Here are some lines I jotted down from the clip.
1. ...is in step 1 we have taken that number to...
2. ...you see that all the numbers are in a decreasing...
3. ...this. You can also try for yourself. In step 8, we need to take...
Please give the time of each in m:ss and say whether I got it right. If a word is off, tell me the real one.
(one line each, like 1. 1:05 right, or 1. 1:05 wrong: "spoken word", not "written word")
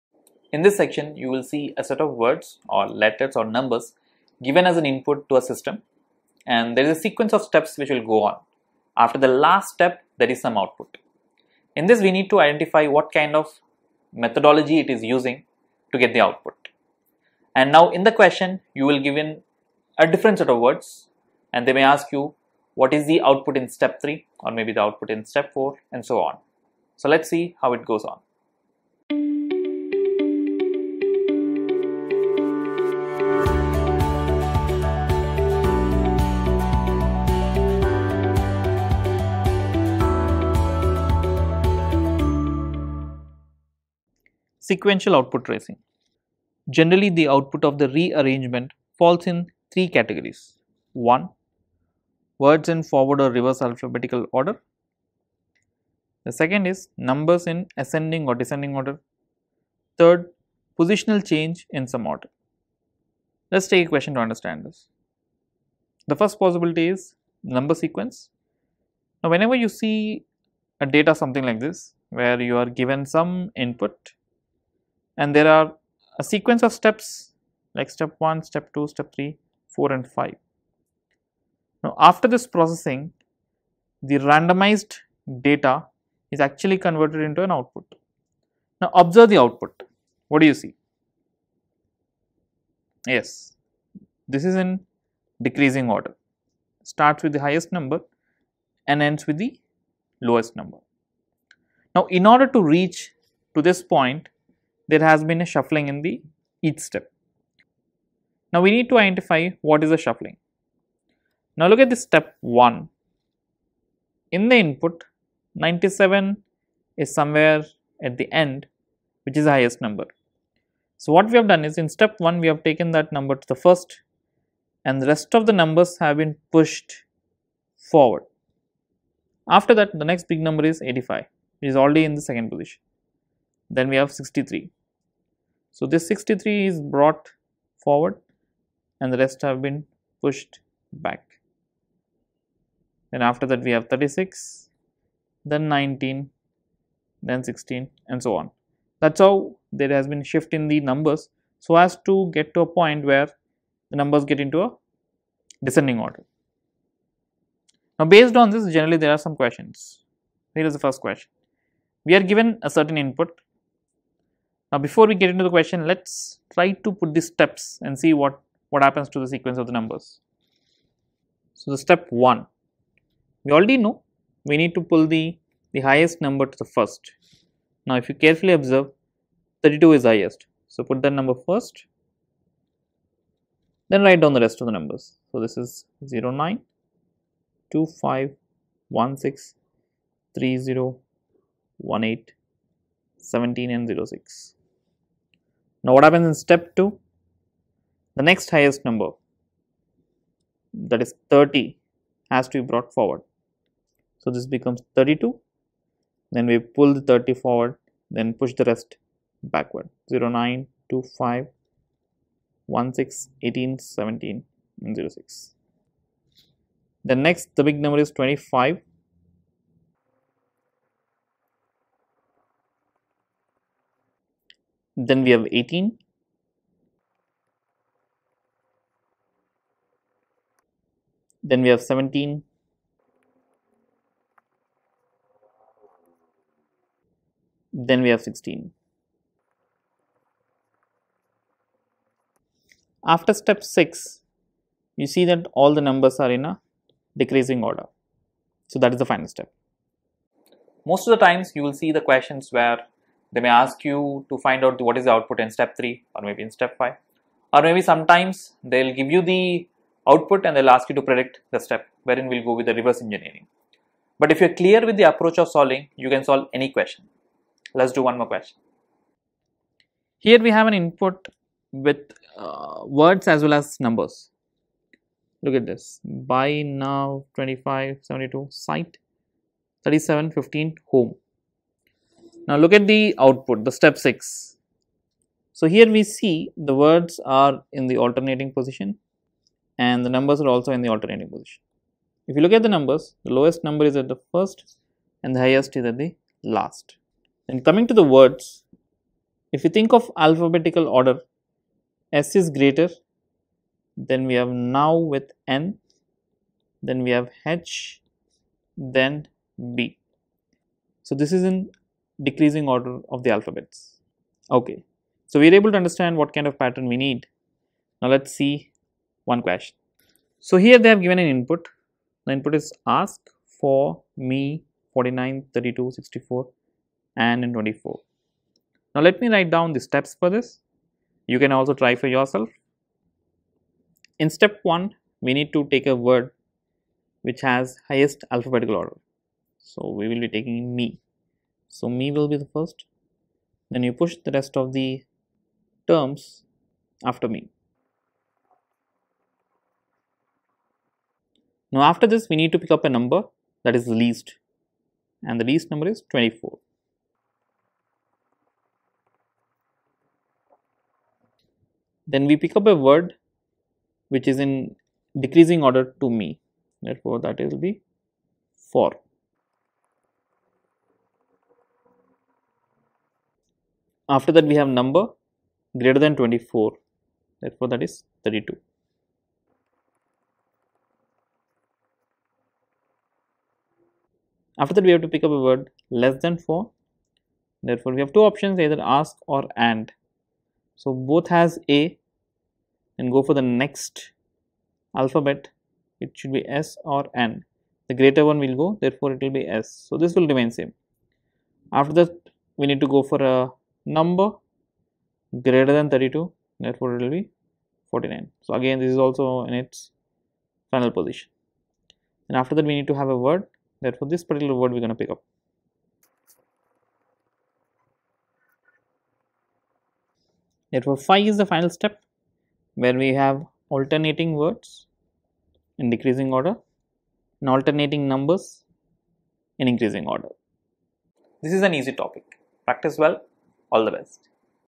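1. 2:01 right
2. 4:04 right
3. 5:30 wrong: "1", not "8".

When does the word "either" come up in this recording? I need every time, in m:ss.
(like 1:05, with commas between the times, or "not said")
6:28.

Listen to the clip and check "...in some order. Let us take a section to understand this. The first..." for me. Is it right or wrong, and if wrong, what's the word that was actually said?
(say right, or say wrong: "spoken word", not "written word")
wrong: "question", not "section".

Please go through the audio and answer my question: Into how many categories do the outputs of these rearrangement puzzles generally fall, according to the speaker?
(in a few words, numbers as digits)
3.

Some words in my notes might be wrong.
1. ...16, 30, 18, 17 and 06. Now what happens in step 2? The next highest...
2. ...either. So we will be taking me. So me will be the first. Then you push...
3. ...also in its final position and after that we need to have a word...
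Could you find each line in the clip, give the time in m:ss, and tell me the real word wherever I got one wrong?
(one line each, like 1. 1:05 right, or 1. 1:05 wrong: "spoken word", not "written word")
1. 3:09 right
2. 5:38 wrong: "order", not "either"
3. 6:48 right.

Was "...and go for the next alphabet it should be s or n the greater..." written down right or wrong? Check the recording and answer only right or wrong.
right.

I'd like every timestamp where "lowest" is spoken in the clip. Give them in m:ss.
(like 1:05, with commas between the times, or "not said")
1:40, 4:53.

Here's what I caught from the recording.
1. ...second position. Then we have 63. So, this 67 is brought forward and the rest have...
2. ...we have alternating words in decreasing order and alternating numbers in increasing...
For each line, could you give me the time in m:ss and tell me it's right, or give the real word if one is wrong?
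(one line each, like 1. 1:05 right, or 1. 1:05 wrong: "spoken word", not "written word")
1. 2:12 wrong: "63", not "67"
2. 7:02 right.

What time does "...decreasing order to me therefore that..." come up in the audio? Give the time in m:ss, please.
6:05.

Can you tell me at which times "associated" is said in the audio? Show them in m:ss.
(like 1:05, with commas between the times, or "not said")
not said.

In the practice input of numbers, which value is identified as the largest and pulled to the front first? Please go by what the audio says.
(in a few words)
32.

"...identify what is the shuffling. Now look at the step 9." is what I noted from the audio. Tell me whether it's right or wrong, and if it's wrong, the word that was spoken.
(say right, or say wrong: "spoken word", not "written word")
wrong: "1", not "9".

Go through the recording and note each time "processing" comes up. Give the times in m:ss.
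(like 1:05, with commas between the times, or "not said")
1:22.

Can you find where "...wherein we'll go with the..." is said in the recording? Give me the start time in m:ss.
4:22.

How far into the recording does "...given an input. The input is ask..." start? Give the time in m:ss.
5:21.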